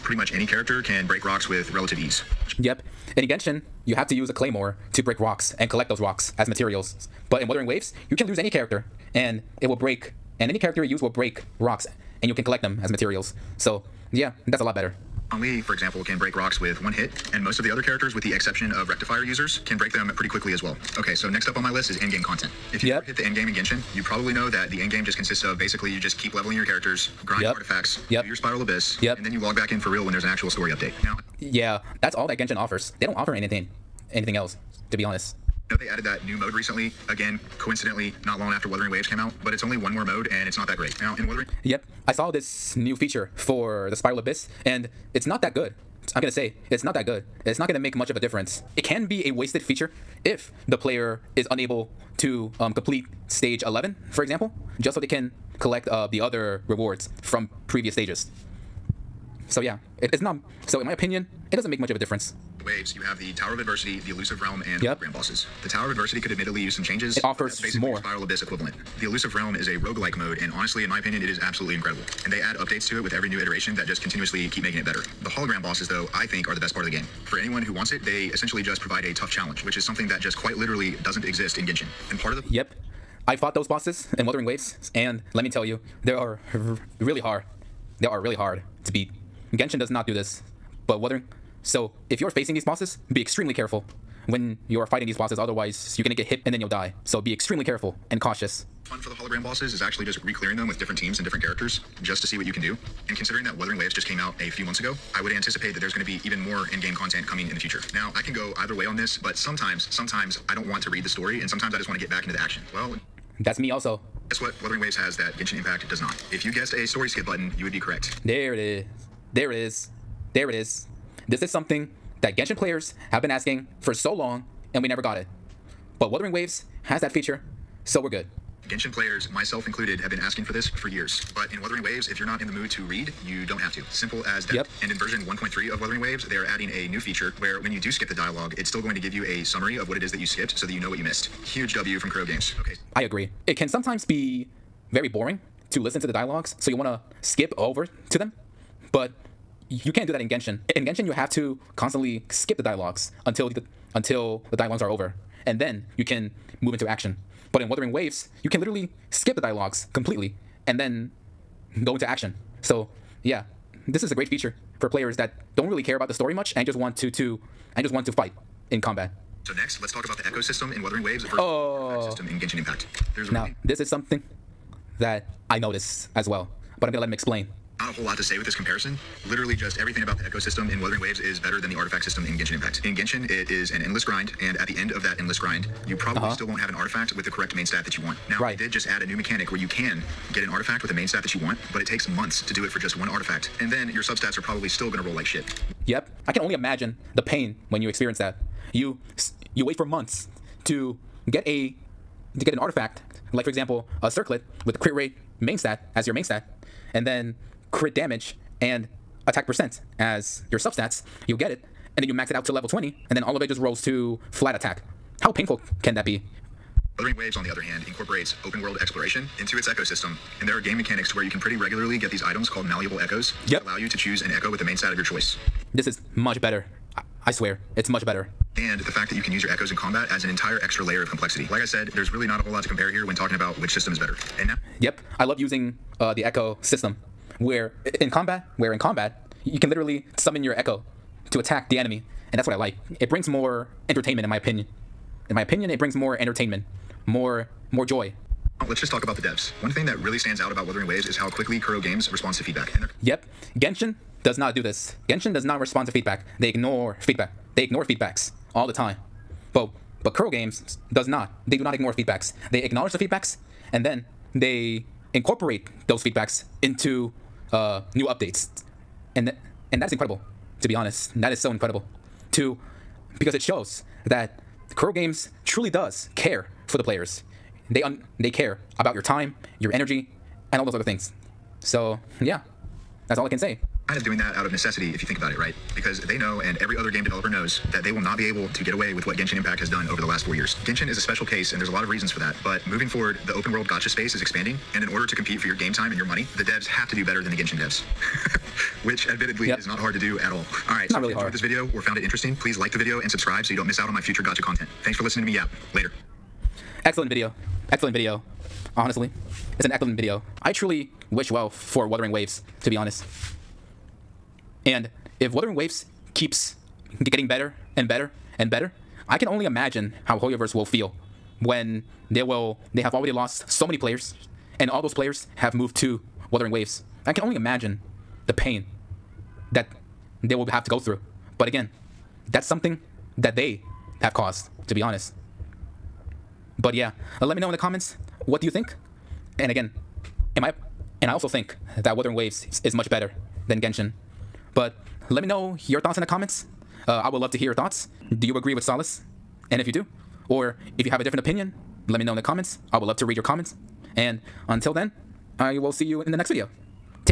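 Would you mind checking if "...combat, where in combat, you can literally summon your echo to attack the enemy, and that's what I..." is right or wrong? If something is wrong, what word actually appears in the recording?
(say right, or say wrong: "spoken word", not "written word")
right.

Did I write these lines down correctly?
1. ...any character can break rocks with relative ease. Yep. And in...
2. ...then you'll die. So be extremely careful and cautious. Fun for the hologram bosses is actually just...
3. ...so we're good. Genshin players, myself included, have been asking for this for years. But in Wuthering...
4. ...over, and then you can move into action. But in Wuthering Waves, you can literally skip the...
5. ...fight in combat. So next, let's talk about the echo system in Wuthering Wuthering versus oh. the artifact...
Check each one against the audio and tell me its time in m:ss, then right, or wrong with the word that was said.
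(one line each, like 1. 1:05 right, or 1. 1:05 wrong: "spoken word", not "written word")
1. 0:00 right
2. 1:36 right
3. 2:07 right
4. 2:34 right
5. 2:48 wrong: "Waves", not "Wuthering".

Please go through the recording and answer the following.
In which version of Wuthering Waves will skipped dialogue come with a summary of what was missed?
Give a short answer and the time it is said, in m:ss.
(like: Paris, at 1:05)
1.3, at 2:15.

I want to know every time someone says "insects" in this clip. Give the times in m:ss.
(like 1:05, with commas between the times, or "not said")
not said.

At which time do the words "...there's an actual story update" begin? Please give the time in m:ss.
0:30.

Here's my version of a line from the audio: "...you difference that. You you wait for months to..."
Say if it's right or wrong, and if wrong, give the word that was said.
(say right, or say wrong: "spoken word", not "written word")
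wrong: "experience", not "difference".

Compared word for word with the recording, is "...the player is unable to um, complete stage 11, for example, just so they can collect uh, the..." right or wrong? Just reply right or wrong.
right.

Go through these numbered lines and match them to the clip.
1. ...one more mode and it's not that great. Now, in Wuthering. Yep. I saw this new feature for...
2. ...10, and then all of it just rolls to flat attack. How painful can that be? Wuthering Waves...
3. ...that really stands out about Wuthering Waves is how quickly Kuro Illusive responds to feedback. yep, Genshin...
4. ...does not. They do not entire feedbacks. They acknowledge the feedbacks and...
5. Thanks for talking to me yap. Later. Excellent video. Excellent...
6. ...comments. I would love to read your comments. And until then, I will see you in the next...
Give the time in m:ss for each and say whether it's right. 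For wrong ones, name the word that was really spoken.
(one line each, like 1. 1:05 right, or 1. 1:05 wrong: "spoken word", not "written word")
1. 0:39 right
2. 3:32 wrong: "20", not "10"
3. 4:09 wrong: "Games", not "Illusive"
4. 4:20 wrong: "ignore", not "entire"
5. 5:04 wrong: "listening", not "talking"
6. 5:52 right.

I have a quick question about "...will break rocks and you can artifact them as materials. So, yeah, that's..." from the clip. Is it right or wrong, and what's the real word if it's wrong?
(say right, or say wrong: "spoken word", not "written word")
wrong: "collect", not "artifact".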